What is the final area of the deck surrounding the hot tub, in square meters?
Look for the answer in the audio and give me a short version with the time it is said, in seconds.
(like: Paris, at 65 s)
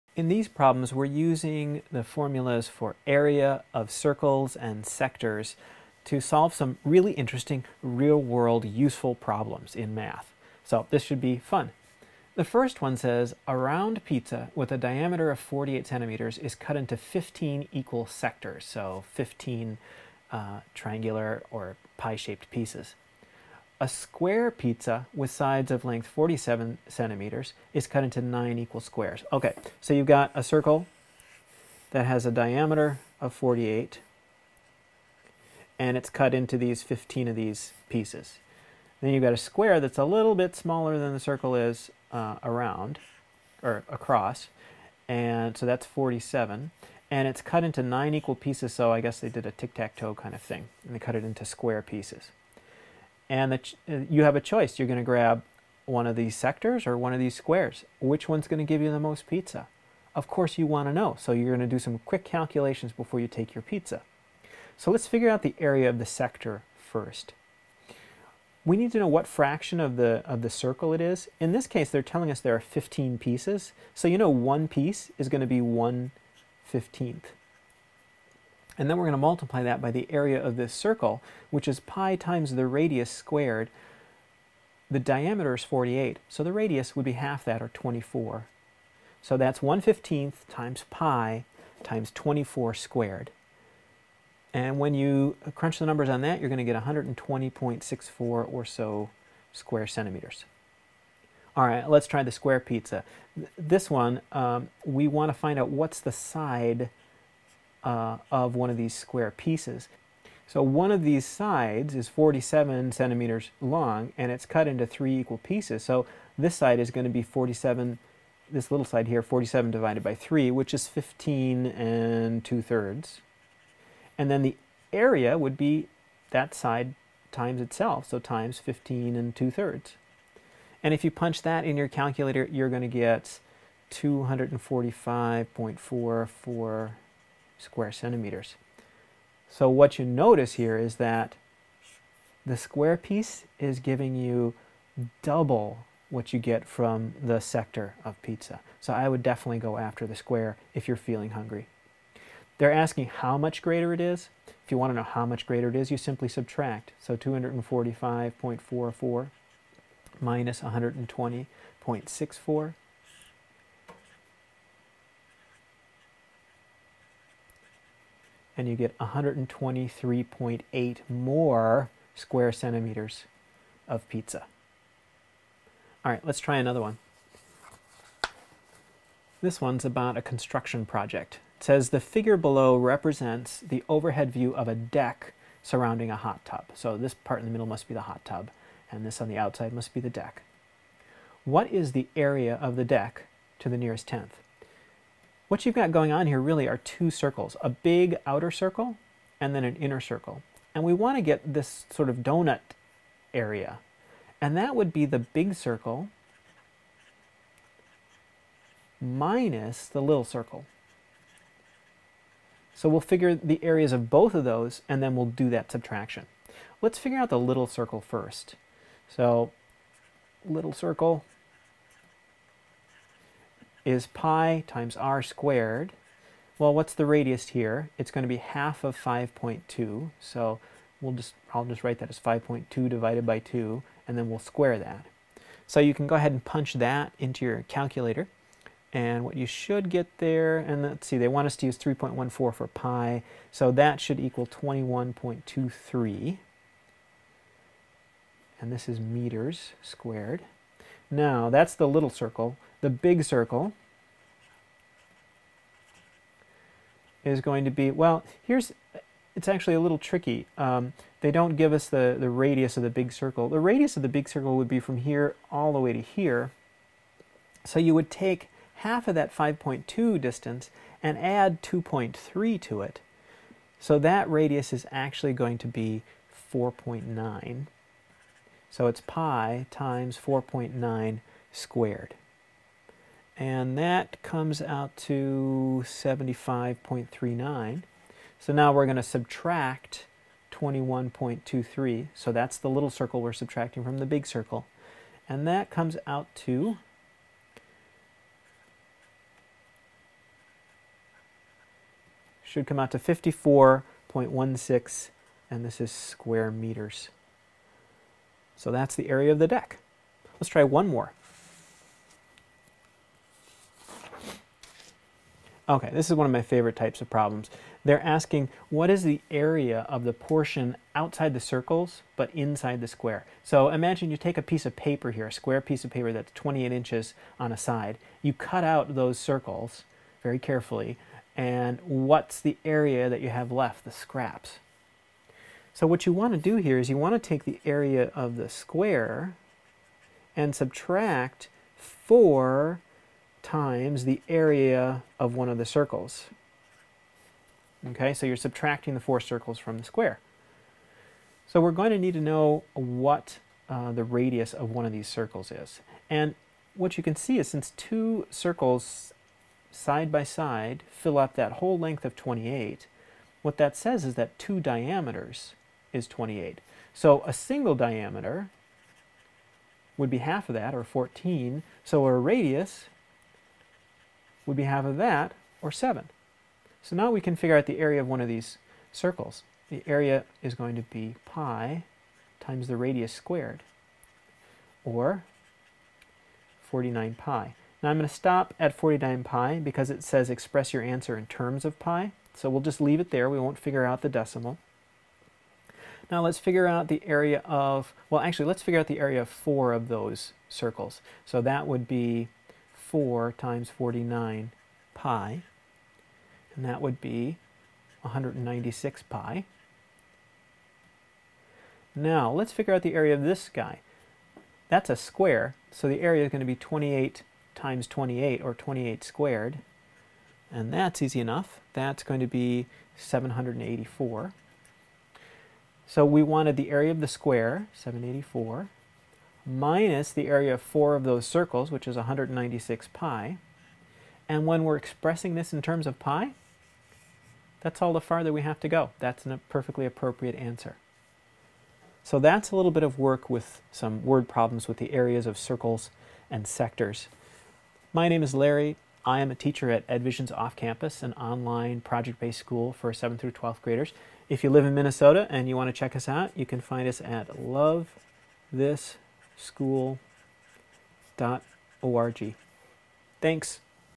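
54.16, at 302 s.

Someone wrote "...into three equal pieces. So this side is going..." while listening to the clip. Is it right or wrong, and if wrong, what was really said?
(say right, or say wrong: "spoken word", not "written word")
right.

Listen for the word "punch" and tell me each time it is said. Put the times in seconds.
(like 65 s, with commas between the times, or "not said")
131 s, 236 s.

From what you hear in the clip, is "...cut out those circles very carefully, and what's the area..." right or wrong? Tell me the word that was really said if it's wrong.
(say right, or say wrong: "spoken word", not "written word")
right.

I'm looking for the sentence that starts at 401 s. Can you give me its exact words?
So that would be 4 times 49 pi, and that would be 196 pi.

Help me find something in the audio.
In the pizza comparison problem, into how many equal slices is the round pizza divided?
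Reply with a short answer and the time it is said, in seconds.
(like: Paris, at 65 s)
15, at 16 s.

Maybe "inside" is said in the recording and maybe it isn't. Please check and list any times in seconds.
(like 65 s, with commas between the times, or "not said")
322 s.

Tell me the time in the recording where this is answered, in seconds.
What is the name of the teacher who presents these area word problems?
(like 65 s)
448 s.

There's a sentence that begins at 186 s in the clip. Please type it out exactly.
So this part in the middle must be the hot tub, and this on the outside must be the deck.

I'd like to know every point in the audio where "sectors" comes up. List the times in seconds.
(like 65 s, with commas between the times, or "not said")
4 s, 18 s, 56 s, 66 s, 147 s, 446 s.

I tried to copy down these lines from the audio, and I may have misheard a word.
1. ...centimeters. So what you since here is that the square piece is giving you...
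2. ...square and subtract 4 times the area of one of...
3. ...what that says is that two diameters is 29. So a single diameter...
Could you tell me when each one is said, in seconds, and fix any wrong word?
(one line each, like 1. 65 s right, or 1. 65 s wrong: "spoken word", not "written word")
1. 137 s wrong: "notice", not "since"
2. 338 s right
3. 363 s wrong: "28", not "29".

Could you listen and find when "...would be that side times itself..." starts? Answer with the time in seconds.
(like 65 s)
125 s.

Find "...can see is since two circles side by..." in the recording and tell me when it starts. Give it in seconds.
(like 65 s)
357 s.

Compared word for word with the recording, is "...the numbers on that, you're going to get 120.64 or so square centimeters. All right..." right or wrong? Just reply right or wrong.
right.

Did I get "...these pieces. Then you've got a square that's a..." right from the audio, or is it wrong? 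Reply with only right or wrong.
right.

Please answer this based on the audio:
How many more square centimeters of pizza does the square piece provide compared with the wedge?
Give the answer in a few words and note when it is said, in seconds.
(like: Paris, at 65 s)
123.8, at 168 s.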